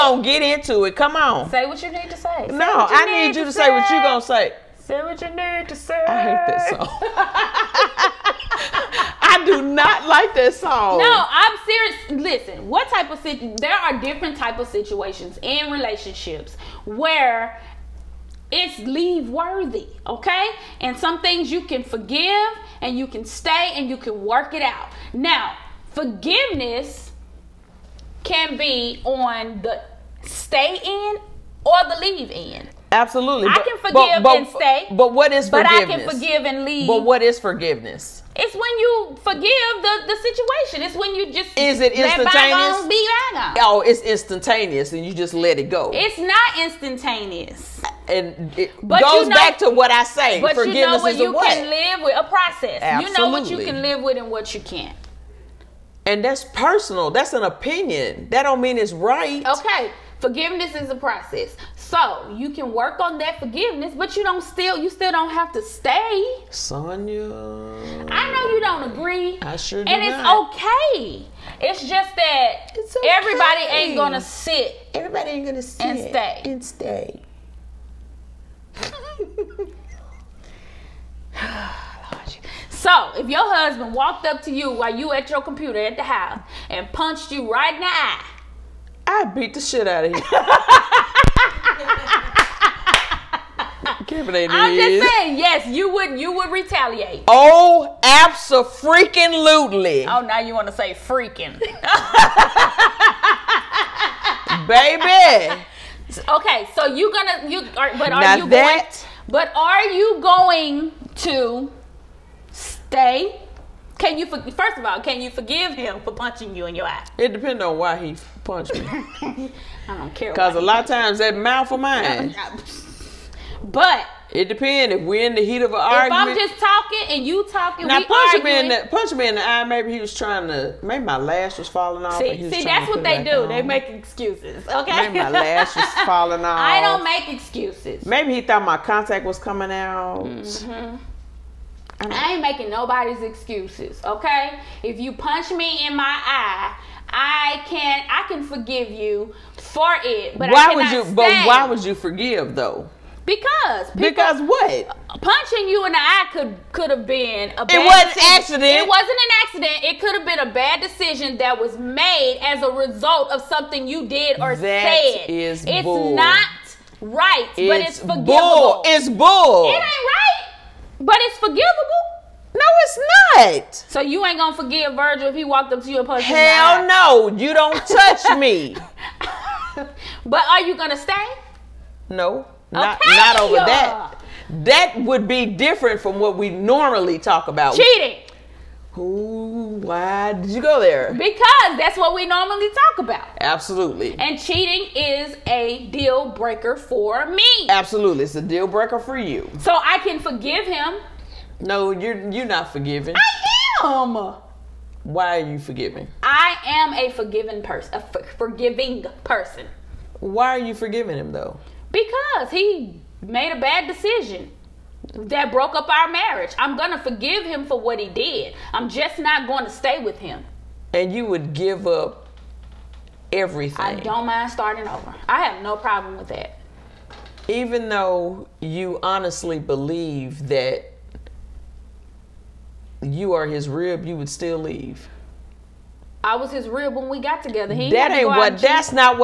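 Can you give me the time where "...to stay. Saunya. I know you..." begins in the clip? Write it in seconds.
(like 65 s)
65 s.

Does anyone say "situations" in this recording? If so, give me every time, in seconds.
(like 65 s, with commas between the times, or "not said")
14 s, 40 s.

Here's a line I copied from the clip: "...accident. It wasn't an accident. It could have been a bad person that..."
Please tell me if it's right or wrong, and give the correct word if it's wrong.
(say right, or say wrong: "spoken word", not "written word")
wrong: "decision", not "person".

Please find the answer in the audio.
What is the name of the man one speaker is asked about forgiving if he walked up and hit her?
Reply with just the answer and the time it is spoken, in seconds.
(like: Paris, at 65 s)
Virgil, at 174 s.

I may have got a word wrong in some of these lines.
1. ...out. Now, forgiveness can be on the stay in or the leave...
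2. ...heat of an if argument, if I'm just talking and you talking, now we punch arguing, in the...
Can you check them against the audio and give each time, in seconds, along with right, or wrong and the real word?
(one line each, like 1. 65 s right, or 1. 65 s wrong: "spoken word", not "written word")
1. 24 s right
2. 125 s right.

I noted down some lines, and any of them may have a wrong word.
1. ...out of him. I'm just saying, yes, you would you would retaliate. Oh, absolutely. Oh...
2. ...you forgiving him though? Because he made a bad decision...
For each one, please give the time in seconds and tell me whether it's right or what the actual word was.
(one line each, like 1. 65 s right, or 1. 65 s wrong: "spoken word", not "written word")
1. 89 s right
2. 210 s right.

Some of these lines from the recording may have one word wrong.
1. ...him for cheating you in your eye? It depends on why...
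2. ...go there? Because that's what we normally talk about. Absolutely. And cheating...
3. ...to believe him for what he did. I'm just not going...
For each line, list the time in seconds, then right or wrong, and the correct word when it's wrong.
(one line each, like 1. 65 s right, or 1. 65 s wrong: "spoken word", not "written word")
1. 115 s wrong: "punching", not "cheating"
2. 190 s right
3. 216 s wrong: "forgive", not "believe".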